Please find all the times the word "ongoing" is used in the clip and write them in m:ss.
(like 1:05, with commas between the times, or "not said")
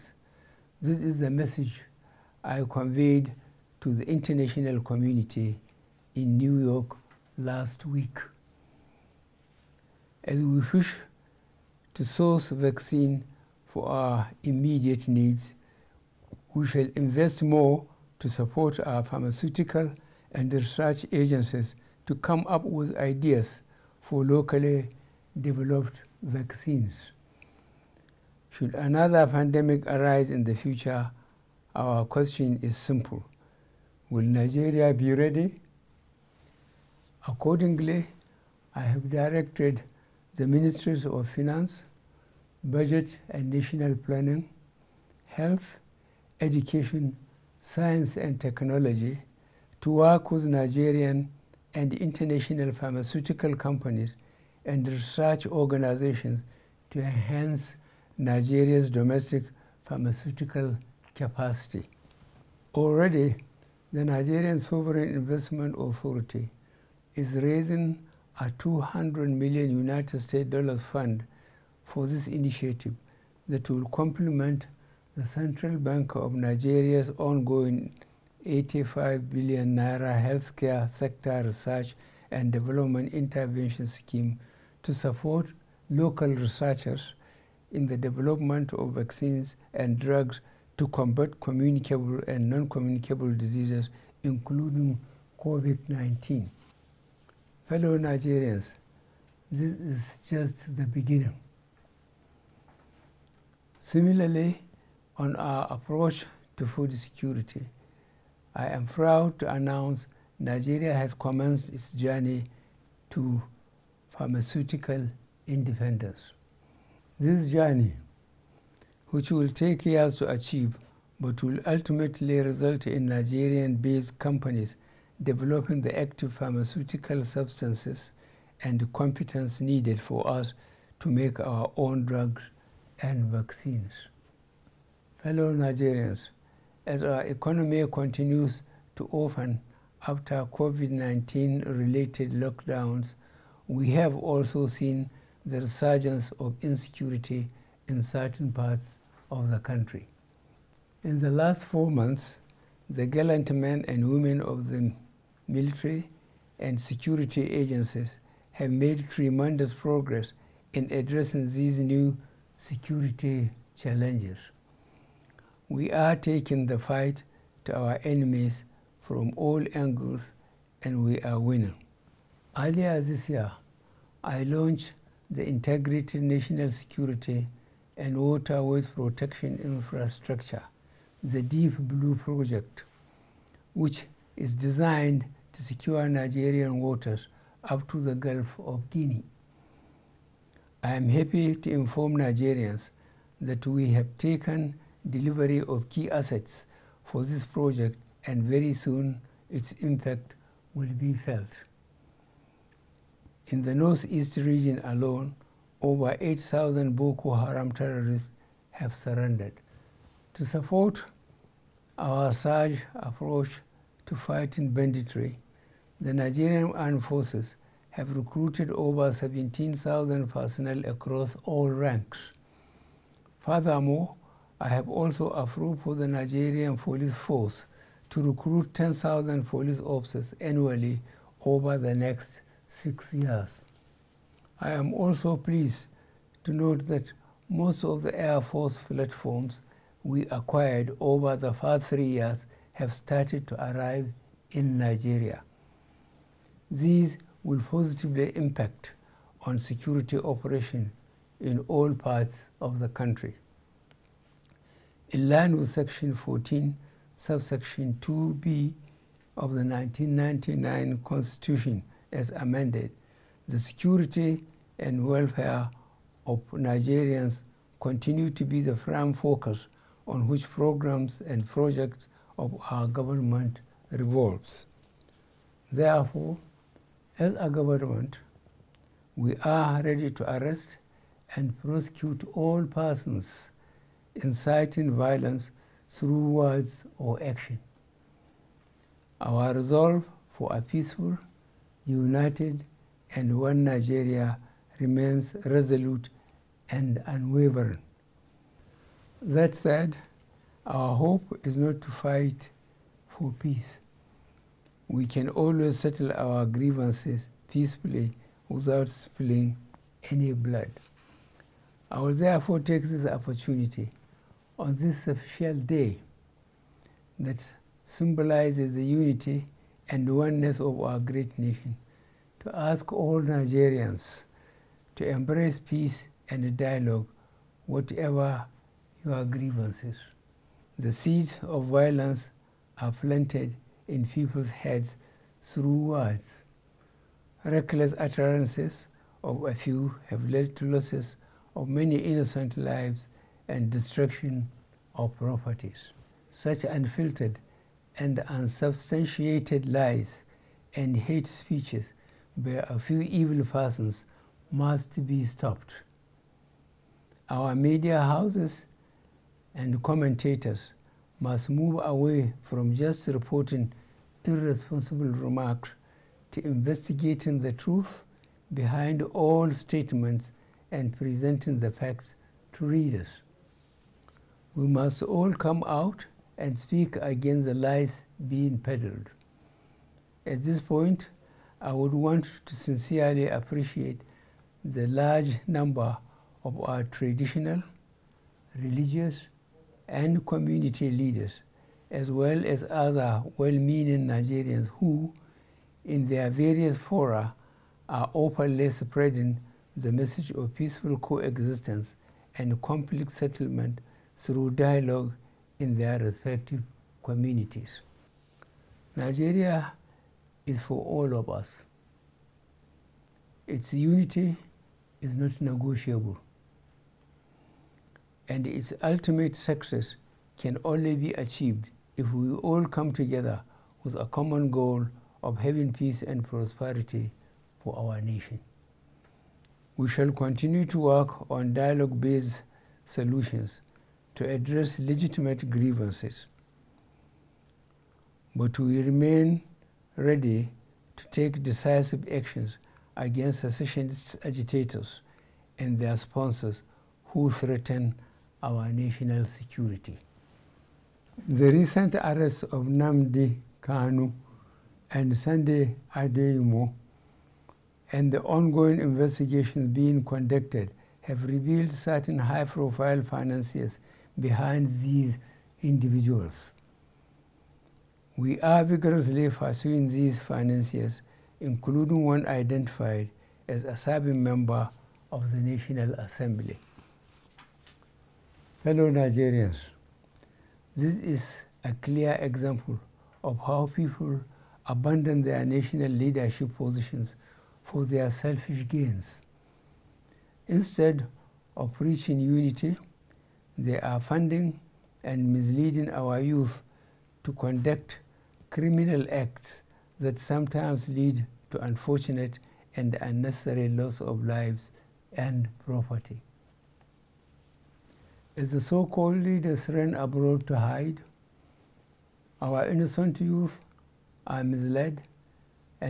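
1:17, 7:38.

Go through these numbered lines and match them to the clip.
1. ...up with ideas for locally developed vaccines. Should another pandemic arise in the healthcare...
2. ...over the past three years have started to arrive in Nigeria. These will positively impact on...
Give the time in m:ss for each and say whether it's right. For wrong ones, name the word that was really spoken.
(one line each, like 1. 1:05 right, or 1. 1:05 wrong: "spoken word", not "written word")
1. 0:22 wrong: "future", not "healthcare"
2. 4:00 right.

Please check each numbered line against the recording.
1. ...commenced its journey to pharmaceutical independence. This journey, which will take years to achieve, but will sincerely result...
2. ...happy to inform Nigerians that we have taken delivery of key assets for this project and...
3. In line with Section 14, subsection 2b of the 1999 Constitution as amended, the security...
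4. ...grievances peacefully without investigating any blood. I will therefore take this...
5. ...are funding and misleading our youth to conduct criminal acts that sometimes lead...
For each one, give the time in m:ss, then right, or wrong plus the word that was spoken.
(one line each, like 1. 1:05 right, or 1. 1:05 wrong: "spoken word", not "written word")
1. 1:51 wrong: "ultimately", not "sincerely"
2. 3:11 right
3. 4:15 right
4. 5:06 wrong: "spilling", not "investigating"
5. 8:13 right.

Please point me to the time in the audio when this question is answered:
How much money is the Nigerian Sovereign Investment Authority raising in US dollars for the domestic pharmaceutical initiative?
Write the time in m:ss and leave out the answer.
1:08.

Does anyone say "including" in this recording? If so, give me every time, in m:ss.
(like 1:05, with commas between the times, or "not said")
1:34, 7:51.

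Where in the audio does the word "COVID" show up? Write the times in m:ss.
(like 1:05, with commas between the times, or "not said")
1:35, 2:20.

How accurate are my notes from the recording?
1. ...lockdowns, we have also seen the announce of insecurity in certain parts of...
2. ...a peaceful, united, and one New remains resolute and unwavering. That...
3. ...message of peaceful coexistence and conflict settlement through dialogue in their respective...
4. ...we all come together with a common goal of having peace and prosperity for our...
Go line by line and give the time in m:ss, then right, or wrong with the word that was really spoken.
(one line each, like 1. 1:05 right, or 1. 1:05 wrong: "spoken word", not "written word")
1. 2:22 wrong: "resurgence", not "announce"
2. 4:50 wrong: "Nigeria", not "New"
3. 6:39 right
4. 7:02 right.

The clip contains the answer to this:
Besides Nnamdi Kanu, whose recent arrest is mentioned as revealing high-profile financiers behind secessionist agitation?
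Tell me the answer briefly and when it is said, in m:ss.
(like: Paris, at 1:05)
Sunday Adeyemo, at 7:35.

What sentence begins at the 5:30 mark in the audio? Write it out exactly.
The seeds of violence are planted in people's heads through words.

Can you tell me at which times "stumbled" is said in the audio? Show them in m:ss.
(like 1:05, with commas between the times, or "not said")
not said.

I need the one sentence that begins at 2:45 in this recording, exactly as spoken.
We are taking the fight to our enemies from all angles and we are winning.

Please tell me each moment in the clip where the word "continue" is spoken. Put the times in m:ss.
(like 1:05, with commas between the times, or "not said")
2:17, 4:27, 7:10.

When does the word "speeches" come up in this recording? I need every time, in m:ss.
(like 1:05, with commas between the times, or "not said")
5:51.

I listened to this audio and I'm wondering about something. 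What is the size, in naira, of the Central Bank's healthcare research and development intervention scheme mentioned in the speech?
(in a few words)
85 billion naira.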